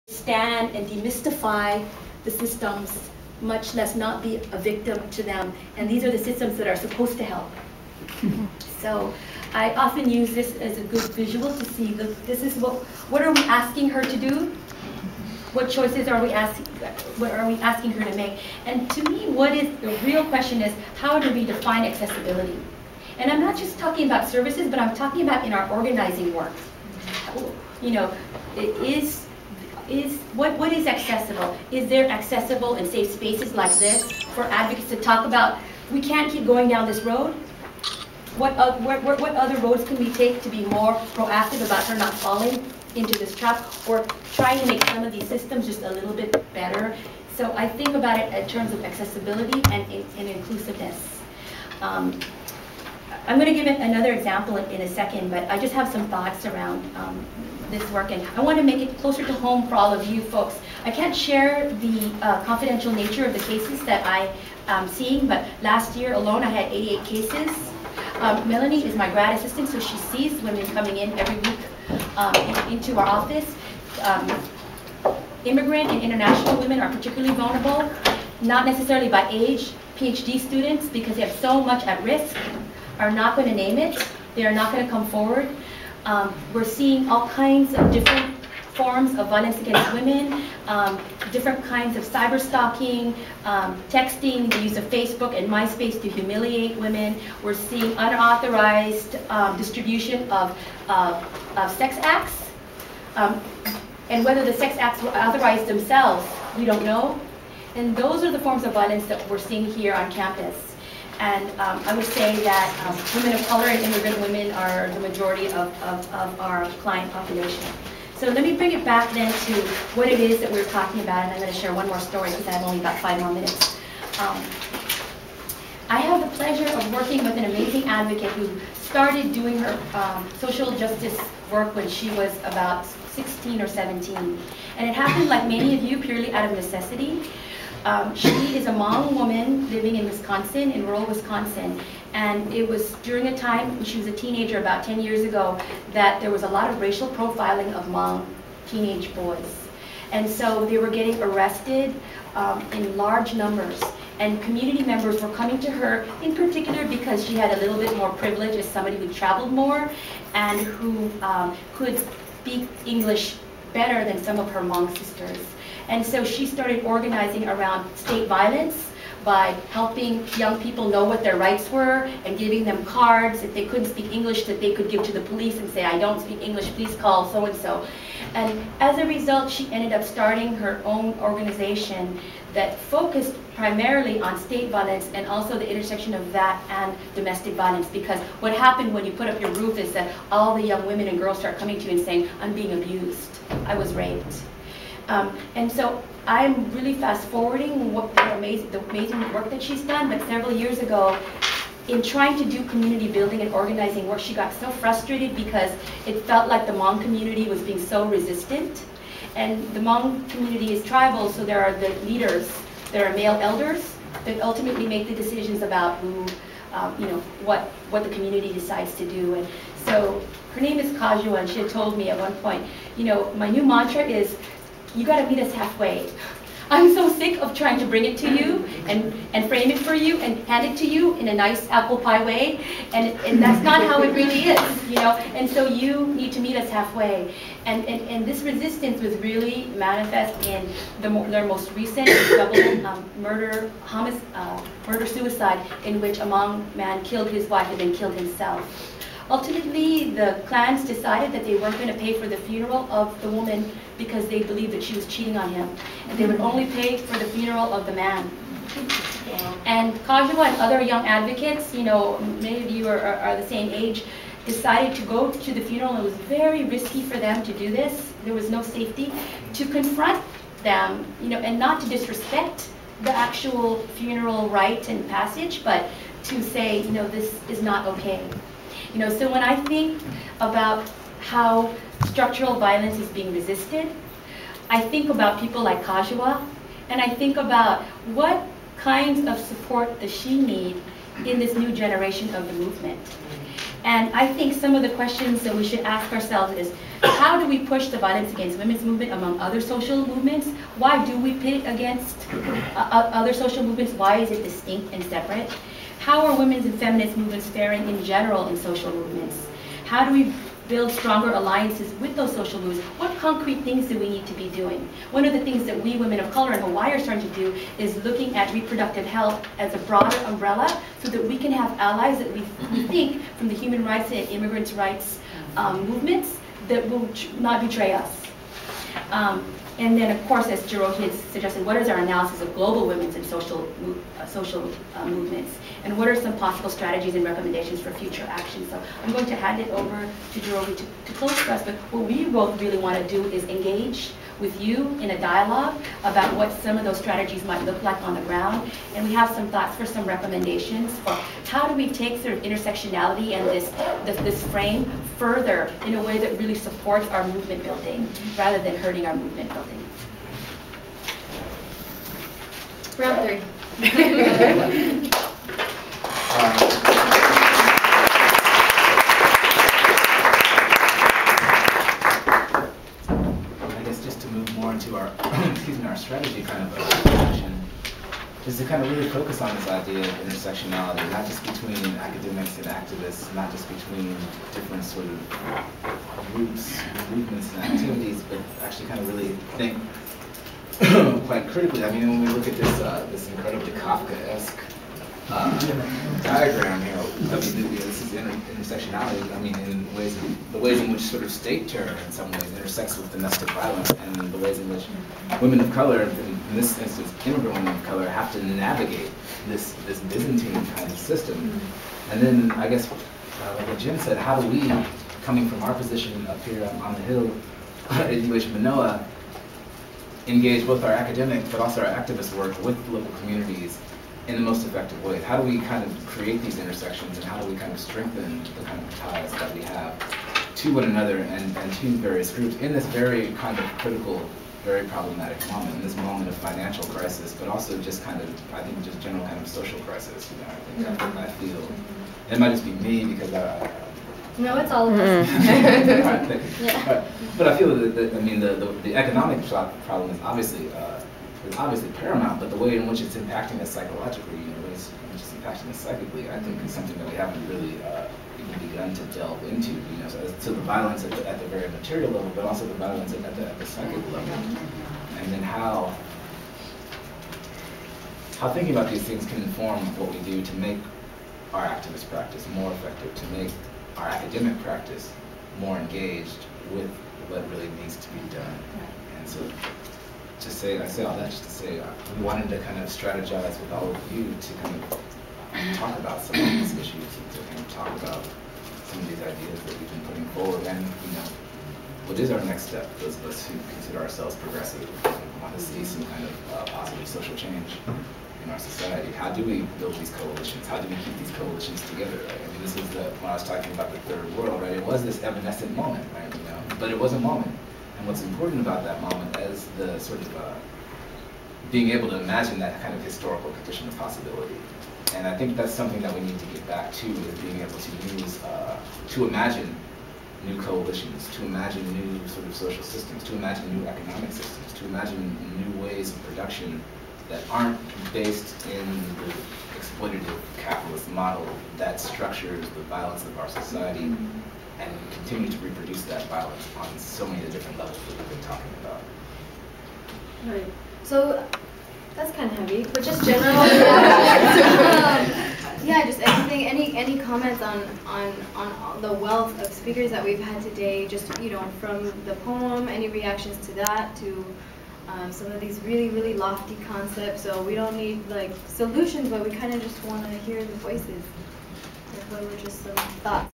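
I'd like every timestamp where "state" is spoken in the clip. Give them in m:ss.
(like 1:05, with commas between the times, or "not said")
2:47, 3:04, 6:41.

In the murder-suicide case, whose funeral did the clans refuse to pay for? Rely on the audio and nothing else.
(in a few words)
the woman's.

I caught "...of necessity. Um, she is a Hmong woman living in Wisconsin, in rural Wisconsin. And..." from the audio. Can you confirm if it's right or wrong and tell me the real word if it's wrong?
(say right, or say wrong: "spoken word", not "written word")
right.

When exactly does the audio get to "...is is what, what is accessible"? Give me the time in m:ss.
0:28.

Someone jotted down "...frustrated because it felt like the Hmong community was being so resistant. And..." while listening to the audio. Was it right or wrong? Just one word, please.
right.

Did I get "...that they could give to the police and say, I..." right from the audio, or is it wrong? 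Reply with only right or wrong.
right.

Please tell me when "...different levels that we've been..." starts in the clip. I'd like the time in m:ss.
8:57.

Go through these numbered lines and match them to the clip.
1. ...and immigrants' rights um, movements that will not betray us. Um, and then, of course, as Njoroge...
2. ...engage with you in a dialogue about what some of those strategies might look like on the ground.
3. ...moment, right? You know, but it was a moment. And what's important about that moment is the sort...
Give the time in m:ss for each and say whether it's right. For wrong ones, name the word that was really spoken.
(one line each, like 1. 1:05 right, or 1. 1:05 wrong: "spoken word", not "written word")
1. 5:24 right
2. 5:43 right
3. 8:25 right.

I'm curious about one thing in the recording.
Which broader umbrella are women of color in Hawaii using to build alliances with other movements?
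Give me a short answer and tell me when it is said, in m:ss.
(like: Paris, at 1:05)
reproductive health, at 5:18.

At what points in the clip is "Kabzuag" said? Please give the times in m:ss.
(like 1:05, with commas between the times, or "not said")
3:40, 4:20, 4:45.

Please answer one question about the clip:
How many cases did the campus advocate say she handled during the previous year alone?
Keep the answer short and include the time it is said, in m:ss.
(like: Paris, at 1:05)
88, at 1:06.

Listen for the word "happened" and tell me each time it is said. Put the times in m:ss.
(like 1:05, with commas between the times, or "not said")
2:14, 3:08.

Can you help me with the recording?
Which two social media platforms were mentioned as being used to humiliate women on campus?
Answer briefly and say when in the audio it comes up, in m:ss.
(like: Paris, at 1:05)
Facebook and MySpace, at 1:34.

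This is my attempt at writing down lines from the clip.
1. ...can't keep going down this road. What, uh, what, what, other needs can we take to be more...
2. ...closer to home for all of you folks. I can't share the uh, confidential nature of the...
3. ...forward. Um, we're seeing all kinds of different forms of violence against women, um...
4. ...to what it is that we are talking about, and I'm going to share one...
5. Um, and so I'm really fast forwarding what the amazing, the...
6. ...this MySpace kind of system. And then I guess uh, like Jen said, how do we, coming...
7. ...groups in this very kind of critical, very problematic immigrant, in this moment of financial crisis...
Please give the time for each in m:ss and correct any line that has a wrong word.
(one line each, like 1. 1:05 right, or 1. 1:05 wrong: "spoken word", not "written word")
1. 0:35 wrong: "roads", not "needs"
2. 0:58 right
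3. 1:25 right
4. 1:59 right
5. 3:15 right
6. 6:49 wrong: "Byzantine", not "MySpace"
7. 7:12 wrong: "moment", not "immigrant".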